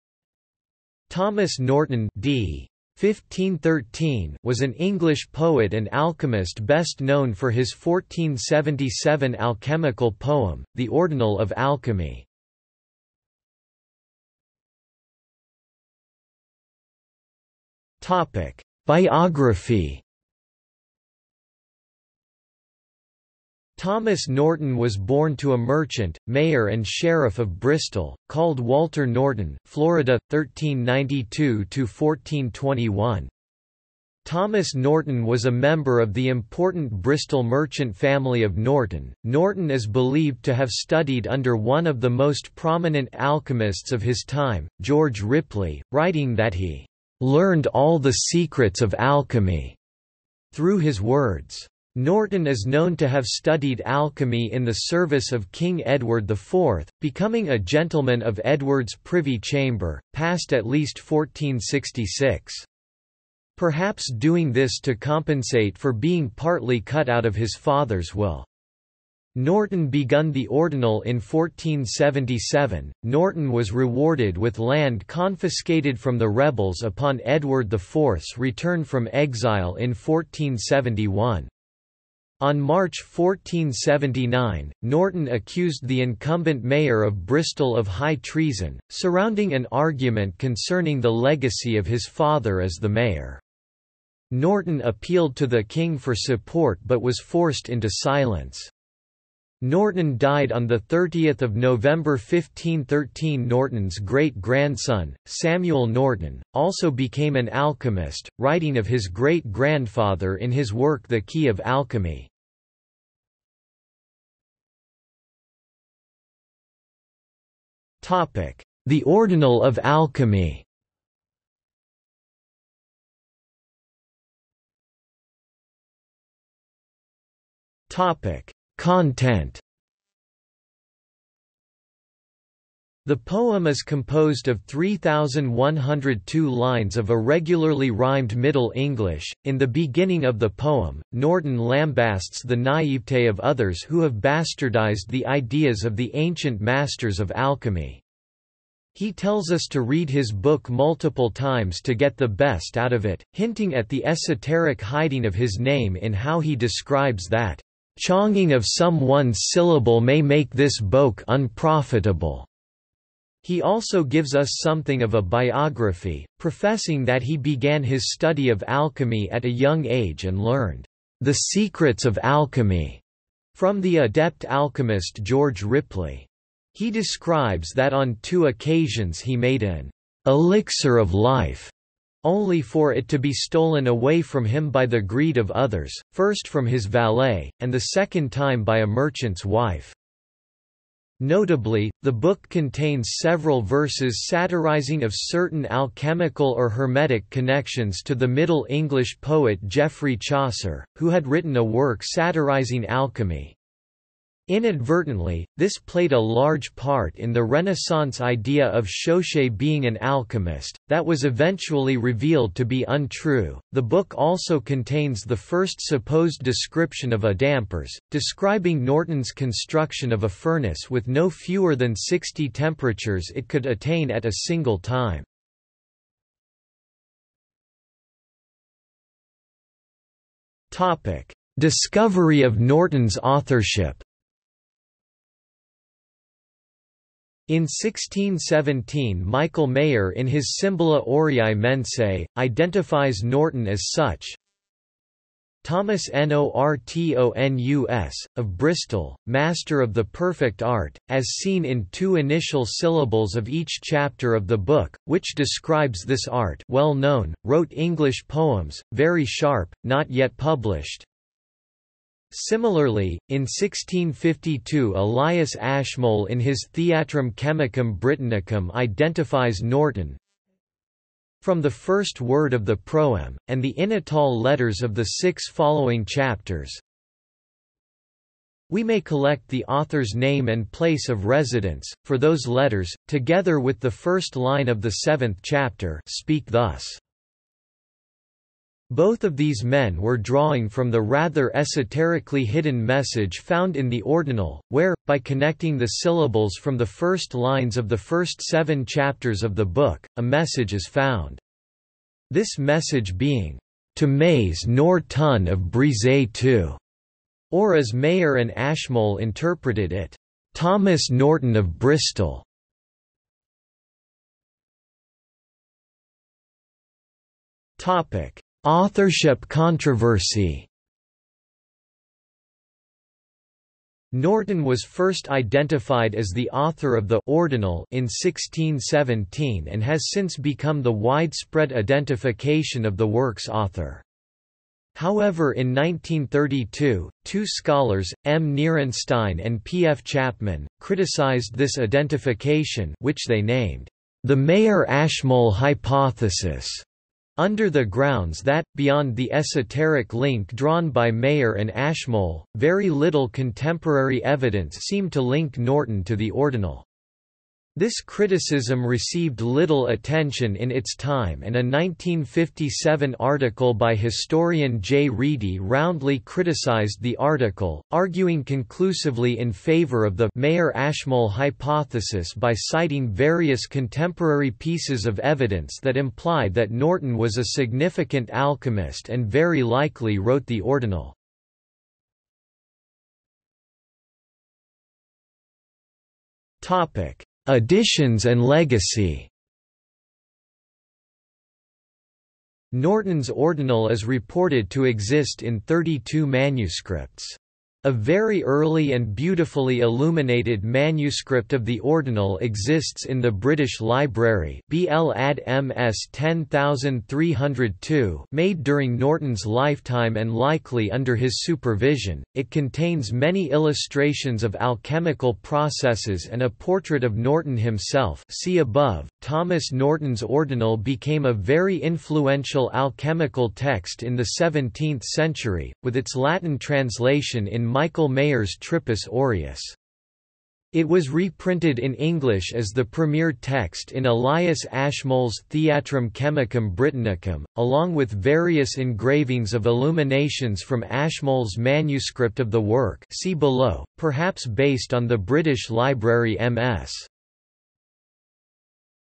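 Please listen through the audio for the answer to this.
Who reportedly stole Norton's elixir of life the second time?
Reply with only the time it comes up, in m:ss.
3:08.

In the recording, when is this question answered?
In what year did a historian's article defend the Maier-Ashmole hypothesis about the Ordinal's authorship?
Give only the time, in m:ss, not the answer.
6:01.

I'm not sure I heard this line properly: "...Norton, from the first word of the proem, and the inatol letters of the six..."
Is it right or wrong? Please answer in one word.
right.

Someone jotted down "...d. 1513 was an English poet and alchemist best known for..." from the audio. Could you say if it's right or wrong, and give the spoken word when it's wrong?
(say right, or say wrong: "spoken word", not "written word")
right.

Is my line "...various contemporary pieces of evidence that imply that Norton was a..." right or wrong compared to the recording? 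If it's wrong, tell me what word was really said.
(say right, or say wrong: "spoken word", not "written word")
right.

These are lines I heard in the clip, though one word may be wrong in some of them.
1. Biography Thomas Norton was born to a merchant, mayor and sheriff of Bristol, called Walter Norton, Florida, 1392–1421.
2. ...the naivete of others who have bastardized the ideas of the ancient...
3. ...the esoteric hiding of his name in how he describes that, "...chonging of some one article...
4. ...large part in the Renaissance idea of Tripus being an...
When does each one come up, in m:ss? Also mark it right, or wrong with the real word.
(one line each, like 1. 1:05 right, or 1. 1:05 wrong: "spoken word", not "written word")
1. 0:18 right
2. 2:22 right
3. 2:33 wrong: "syllable", not "article"
4. 3:26 wrong: "Chaucer", not "Tripus".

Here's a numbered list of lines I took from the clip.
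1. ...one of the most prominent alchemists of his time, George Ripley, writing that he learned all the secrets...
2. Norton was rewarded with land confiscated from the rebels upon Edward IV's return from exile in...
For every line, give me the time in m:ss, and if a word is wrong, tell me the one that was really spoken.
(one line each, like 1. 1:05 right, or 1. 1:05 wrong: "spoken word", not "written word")
1. 0:41 right
2. 1:13 right.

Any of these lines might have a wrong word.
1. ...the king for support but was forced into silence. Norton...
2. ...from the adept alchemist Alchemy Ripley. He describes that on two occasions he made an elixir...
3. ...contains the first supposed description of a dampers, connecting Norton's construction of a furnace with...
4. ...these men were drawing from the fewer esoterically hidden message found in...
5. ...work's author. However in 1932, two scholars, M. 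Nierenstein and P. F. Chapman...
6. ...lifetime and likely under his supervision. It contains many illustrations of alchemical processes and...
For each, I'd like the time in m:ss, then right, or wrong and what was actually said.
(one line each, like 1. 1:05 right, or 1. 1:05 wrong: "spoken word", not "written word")
1. 1:35 right
2. 2:53 wrong: "George", not "Alchemy"
3. 3:34 wrong: "describing", not "connecting"
4. 4:49 wrong: "rather", not "fewer"
5. 5:33 right
6. 6:49 right.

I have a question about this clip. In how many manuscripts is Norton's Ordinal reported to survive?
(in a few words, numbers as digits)
32.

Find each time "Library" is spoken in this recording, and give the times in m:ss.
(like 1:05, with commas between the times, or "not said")
6:43, 7:25.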